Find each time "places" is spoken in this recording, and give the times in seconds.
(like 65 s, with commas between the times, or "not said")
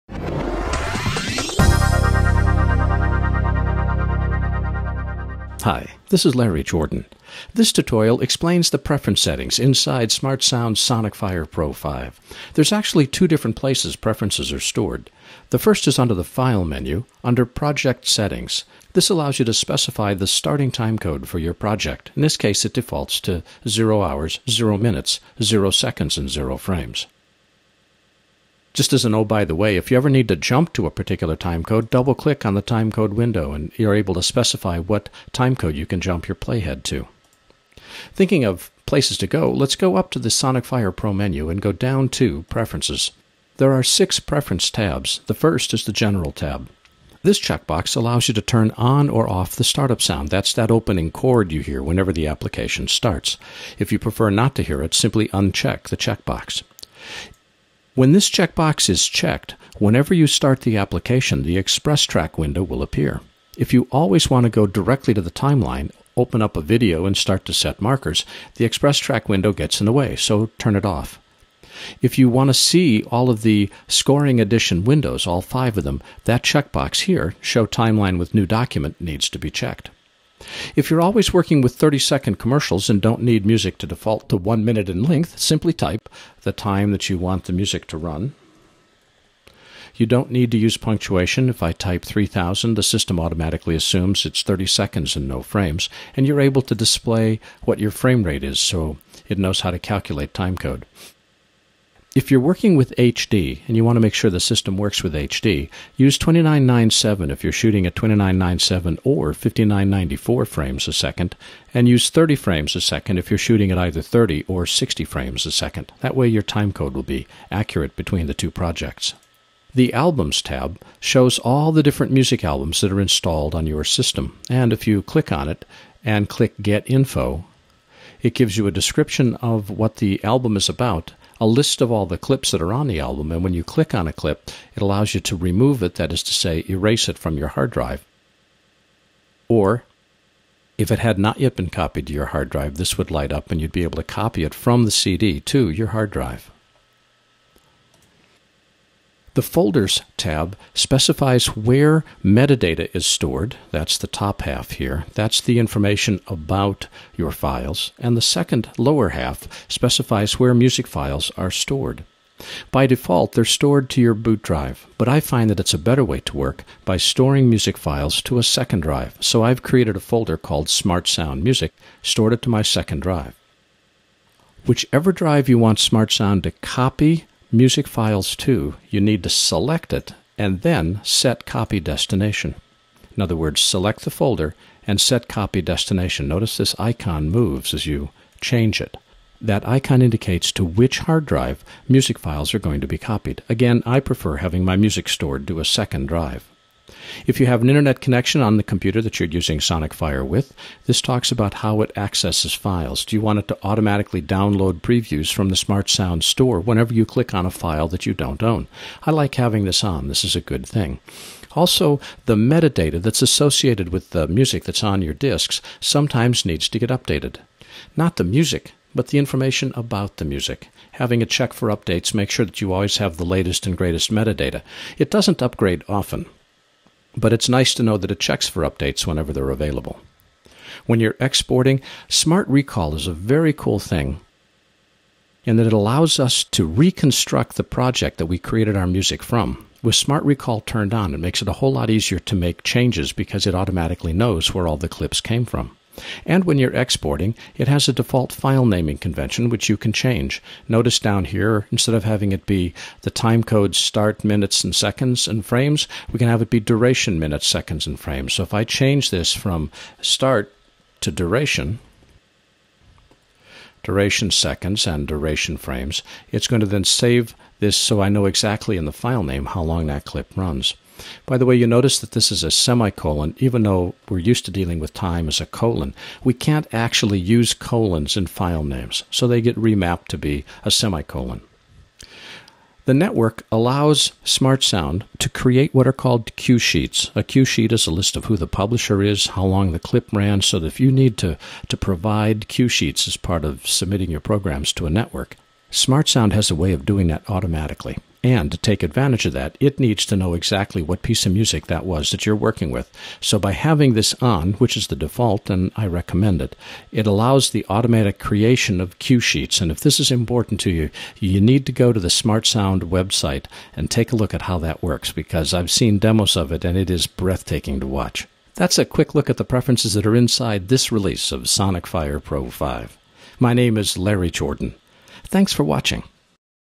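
13 s, 38 s.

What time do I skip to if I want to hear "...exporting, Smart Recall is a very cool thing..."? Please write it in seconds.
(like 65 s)
231 s.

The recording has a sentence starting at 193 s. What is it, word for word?
Again, I prefer having my music stored to a second drive.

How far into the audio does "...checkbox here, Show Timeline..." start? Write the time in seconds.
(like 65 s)
76 s.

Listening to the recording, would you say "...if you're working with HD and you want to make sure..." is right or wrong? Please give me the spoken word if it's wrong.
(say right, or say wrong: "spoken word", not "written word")
right.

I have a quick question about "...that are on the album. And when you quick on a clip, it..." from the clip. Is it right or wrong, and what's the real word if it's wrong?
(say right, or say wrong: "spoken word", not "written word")
wrong: "click", not "quick".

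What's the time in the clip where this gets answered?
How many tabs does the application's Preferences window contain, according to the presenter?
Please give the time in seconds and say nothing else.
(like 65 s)
43 s.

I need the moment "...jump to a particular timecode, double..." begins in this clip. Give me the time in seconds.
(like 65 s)
30 s.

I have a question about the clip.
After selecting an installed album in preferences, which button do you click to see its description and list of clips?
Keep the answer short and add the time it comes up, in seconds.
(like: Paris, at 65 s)
Get Info, at 126 s.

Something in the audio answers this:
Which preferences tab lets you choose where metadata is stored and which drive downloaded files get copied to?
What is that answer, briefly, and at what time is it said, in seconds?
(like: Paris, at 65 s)
Folders tab, at 149 s.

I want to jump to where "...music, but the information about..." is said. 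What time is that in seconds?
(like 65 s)
218 s.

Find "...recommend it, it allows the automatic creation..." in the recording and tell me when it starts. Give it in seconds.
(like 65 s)
305 s.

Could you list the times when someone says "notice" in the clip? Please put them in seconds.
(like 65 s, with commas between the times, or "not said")
186 s, 250 s, 271 s.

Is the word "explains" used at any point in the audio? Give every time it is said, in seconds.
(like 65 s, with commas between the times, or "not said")
8 s.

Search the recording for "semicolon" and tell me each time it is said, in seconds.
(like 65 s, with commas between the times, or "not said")
272 s, 280 s.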